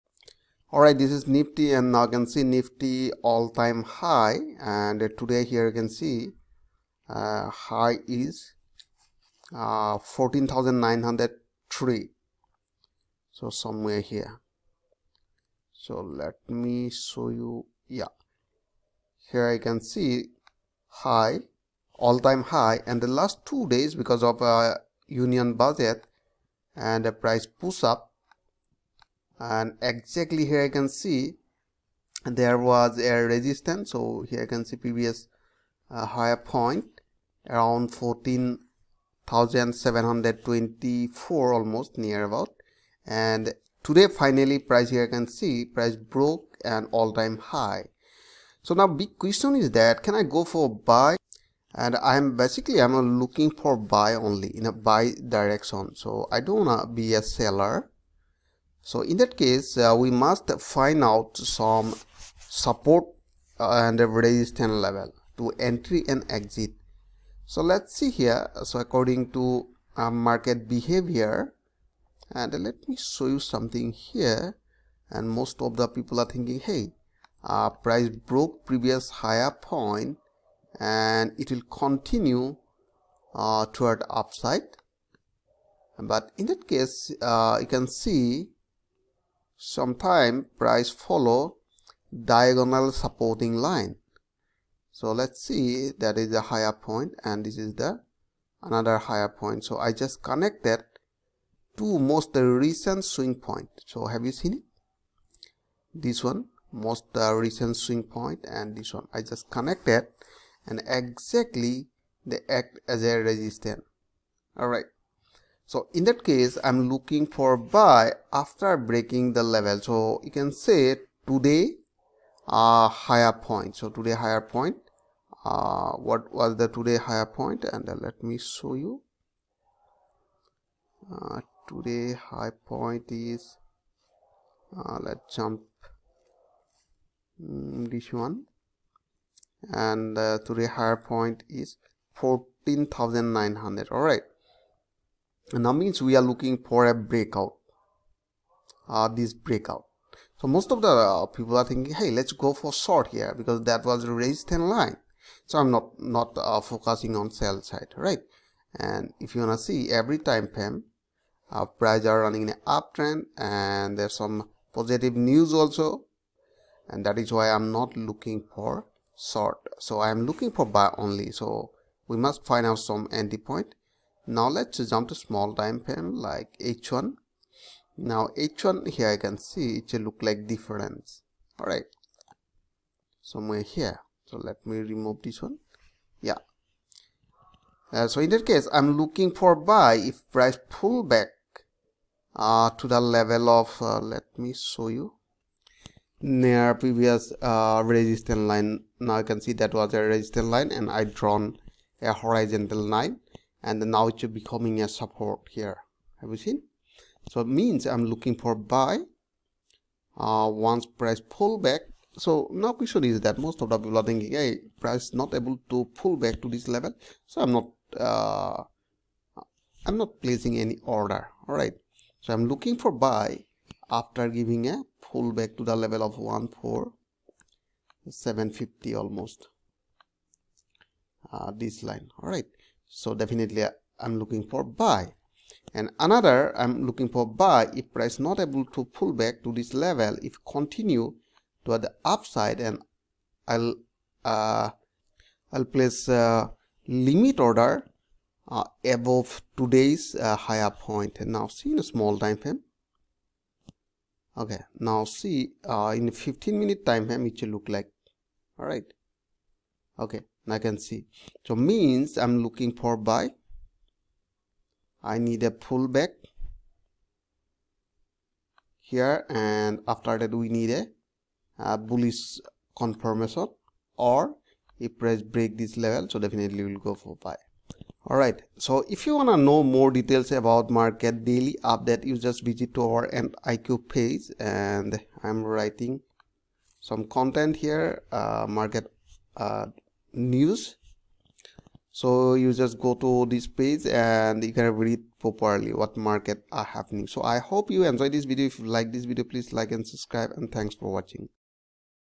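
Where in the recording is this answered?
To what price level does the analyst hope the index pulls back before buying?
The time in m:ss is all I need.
3:46.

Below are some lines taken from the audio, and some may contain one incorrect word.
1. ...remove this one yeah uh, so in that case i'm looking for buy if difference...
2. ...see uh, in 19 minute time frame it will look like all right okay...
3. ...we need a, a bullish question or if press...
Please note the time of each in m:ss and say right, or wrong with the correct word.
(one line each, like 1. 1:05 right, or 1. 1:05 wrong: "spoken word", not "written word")
1. 3:04 wrong: "price", not "difference"
2. 4:15 wrong: "15", not "19"
3. 4:30 wrong: "confirmation", not "question".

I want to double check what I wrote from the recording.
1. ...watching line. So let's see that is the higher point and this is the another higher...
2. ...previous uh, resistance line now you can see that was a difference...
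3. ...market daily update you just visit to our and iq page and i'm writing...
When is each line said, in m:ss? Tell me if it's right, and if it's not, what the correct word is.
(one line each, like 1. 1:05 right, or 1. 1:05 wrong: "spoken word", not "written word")
1. 1:32 wrong: "supporting", not "watching"
2. 3:16 wrong: "resistance", not "difference"
3. 4:40 right.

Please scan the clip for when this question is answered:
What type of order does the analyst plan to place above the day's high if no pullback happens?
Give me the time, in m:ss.
4:06.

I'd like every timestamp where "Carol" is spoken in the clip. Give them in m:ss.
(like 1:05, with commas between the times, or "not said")
not said.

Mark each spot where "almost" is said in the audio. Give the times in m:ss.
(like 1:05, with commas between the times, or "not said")
0:41, 3:48.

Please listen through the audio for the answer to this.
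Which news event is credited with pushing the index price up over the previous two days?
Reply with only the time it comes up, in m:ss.
0:25.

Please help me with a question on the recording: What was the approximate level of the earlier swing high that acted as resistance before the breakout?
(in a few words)
14,724.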